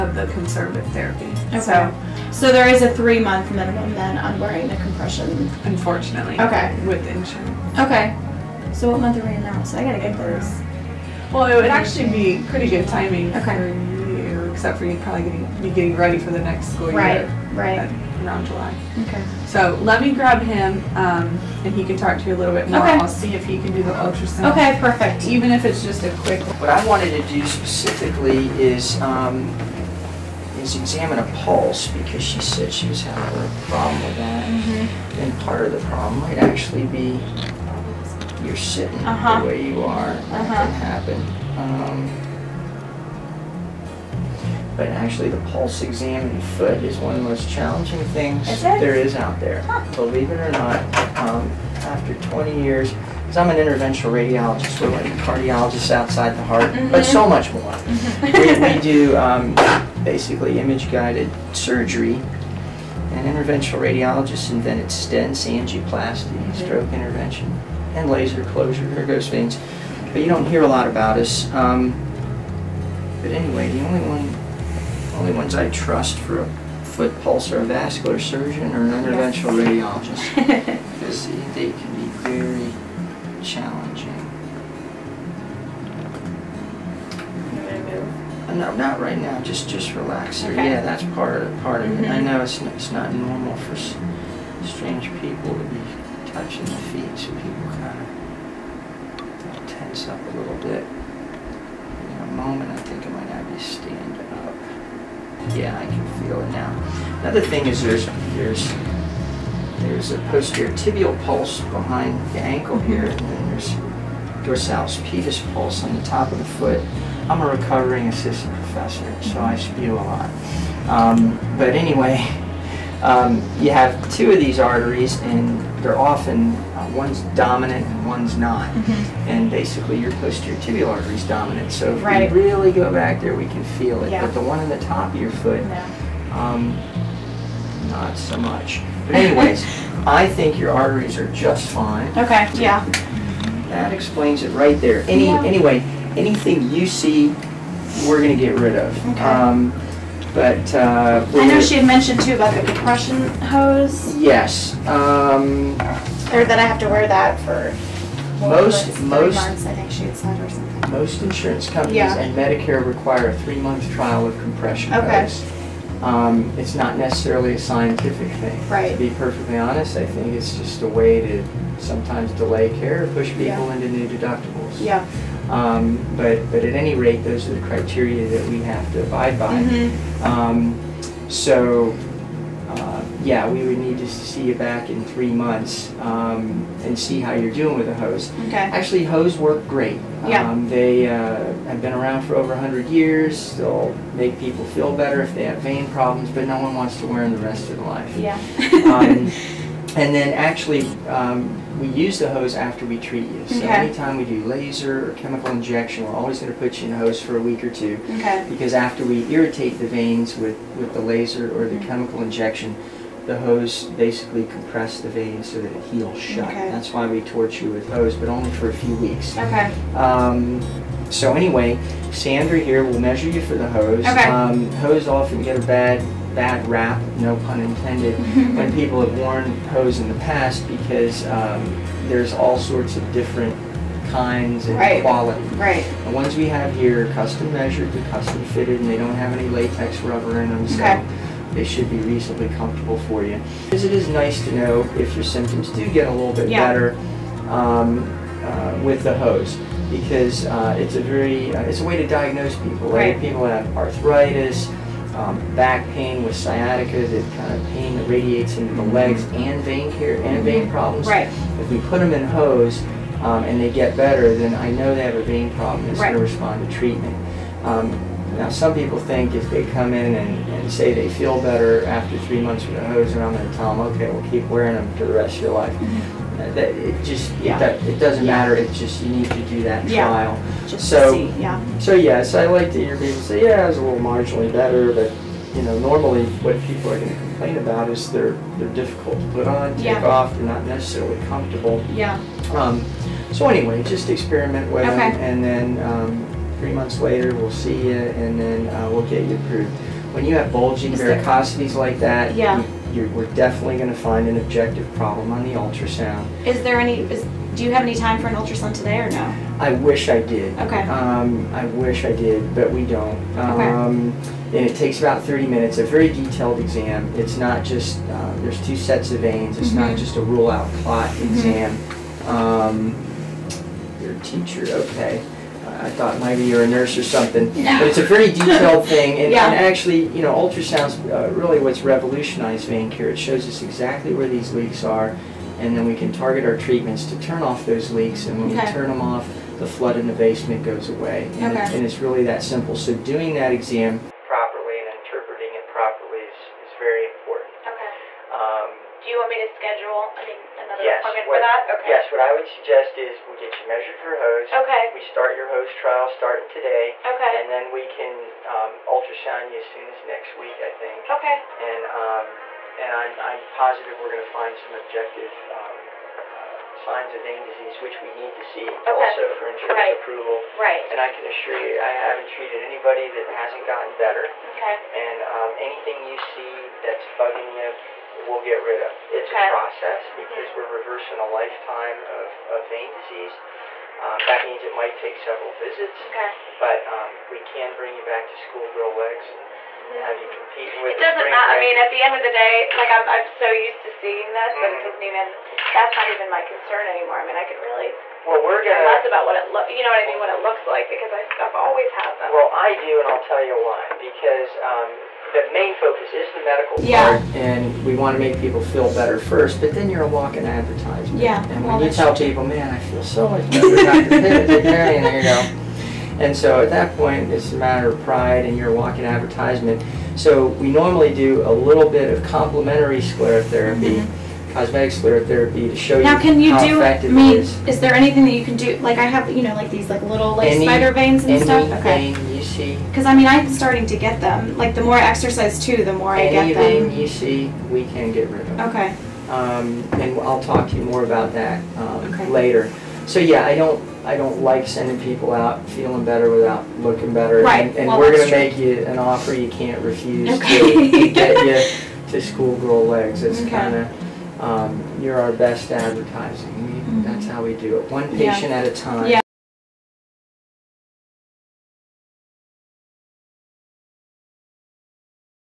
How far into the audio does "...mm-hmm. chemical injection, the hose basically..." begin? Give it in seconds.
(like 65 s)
211 s.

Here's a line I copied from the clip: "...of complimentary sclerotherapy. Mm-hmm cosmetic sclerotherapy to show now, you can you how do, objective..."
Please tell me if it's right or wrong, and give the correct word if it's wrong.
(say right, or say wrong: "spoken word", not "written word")
wrong: "effective", not "objective".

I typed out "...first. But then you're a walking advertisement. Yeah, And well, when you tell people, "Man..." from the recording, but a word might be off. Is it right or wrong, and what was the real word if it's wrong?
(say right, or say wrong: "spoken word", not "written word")
right.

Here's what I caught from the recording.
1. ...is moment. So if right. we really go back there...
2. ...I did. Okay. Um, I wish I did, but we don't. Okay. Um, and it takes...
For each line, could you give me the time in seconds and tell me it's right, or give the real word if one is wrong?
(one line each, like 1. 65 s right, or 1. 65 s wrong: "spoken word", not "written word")
1. 131 s wrong: "dominant", not "moment"
2. 310 s right.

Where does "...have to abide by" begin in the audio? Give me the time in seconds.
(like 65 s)
178 s.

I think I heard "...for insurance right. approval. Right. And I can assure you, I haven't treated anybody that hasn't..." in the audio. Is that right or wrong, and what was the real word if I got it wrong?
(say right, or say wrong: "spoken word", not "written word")
right.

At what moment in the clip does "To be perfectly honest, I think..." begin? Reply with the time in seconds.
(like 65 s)
168 s.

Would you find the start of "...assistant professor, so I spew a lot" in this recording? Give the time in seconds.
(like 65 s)
118 s.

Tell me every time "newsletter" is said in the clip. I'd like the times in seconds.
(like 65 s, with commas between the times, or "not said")
not said.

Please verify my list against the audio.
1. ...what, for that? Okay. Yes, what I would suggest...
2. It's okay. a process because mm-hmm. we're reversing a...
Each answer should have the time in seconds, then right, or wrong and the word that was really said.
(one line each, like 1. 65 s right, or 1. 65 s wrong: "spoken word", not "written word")
1. 351 s right
2. 379 s right.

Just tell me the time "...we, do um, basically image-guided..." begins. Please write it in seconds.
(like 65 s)
58 s.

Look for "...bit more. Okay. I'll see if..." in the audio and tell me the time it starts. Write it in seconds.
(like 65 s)
22 s.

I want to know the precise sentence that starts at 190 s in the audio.
Um, they uh, have been around for over 100 years.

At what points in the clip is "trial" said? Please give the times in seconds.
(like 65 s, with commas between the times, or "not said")
163 s, 280 s, 355 s.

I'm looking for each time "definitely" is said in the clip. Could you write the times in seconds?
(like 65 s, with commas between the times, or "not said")
303 s.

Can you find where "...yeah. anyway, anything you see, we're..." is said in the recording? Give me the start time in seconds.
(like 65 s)
145 s.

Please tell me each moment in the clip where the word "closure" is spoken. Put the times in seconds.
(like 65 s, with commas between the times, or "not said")
68 s.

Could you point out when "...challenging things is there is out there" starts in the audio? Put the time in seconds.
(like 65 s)
47 s.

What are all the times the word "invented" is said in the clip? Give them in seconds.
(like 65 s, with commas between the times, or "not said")
64 s.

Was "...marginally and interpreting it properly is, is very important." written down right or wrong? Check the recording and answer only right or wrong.
wrong.